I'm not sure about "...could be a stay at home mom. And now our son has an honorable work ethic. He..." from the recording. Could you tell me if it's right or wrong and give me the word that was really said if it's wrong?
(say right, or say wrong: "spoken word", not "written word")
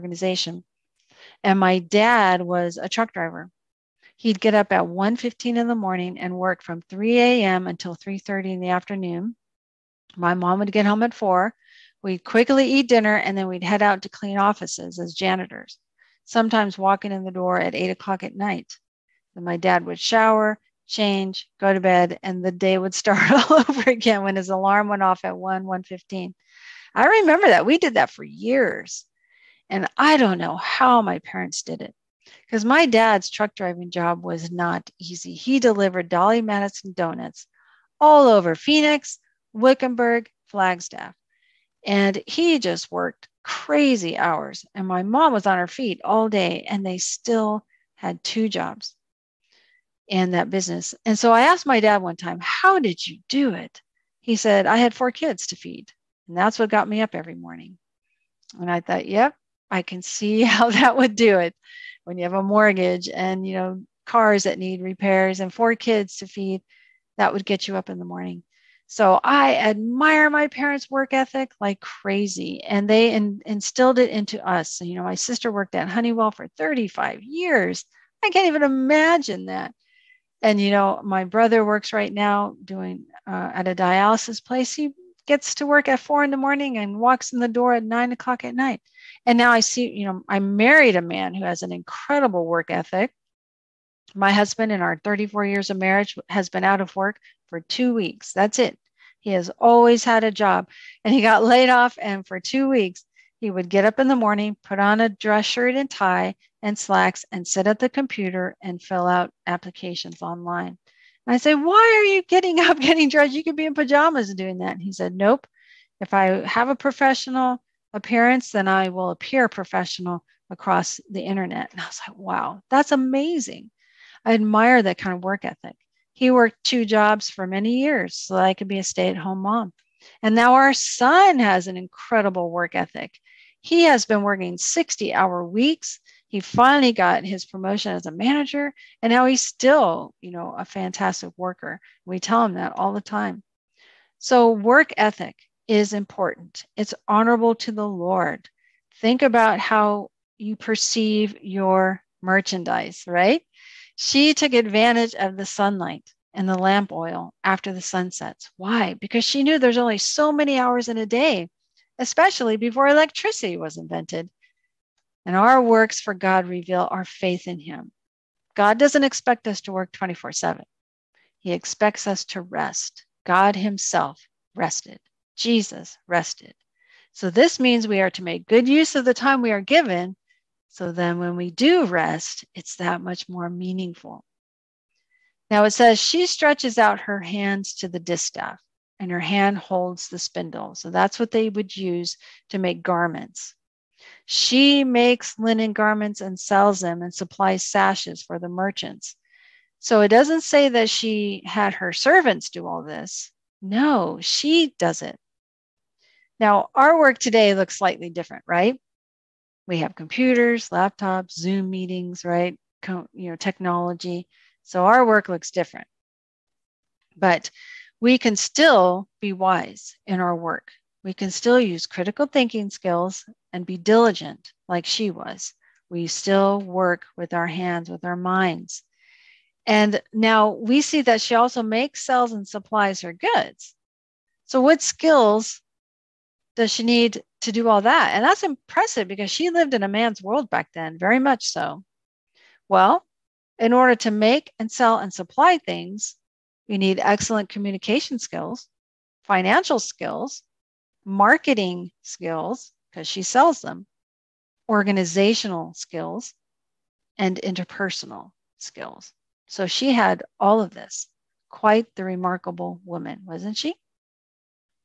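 wrong: "incredible", not "honorable".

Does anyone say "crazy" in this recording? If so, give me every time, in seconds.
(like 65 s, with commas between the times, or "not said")
43 s, 71 s.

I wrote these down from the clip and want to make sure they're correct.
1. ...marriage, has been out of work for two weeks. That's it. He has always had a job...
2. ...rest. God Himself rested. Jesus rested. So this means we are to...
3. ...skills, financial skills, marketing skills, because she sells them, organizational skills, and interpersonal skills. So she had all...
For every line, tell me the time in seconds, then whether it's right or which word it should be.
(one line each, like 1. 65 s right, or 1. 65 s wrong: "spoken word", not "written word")
1. 95 s right
2. 172 s right
3. 248 s right.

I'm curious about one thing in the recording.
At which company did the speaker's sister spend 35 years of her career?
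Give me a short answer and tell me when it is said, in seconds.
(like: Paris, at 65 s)
Honeywell, at 75 s.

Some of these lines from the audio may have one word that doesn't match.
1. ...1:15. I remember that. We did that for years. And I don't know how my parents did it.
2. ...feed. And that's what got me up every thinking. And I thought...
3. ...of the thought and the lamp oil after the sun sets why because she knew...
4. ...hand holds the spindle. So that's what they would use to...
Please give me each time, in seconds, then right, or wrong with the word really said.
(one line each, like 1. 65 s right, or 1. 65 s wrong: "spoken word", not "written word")
1. 25 s right
2. 55 s wrong: "morning", not "thinking"
3. 155 s wrong: "sunlight", not "thought"
4. 189 s right.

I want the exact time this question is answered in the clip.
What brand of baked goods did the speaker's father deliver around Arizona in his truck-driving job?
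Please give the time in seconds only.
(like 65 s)
36 s.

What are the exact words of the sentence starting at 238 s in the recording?
And that's impressive because she lived in a man's world back then, very much so.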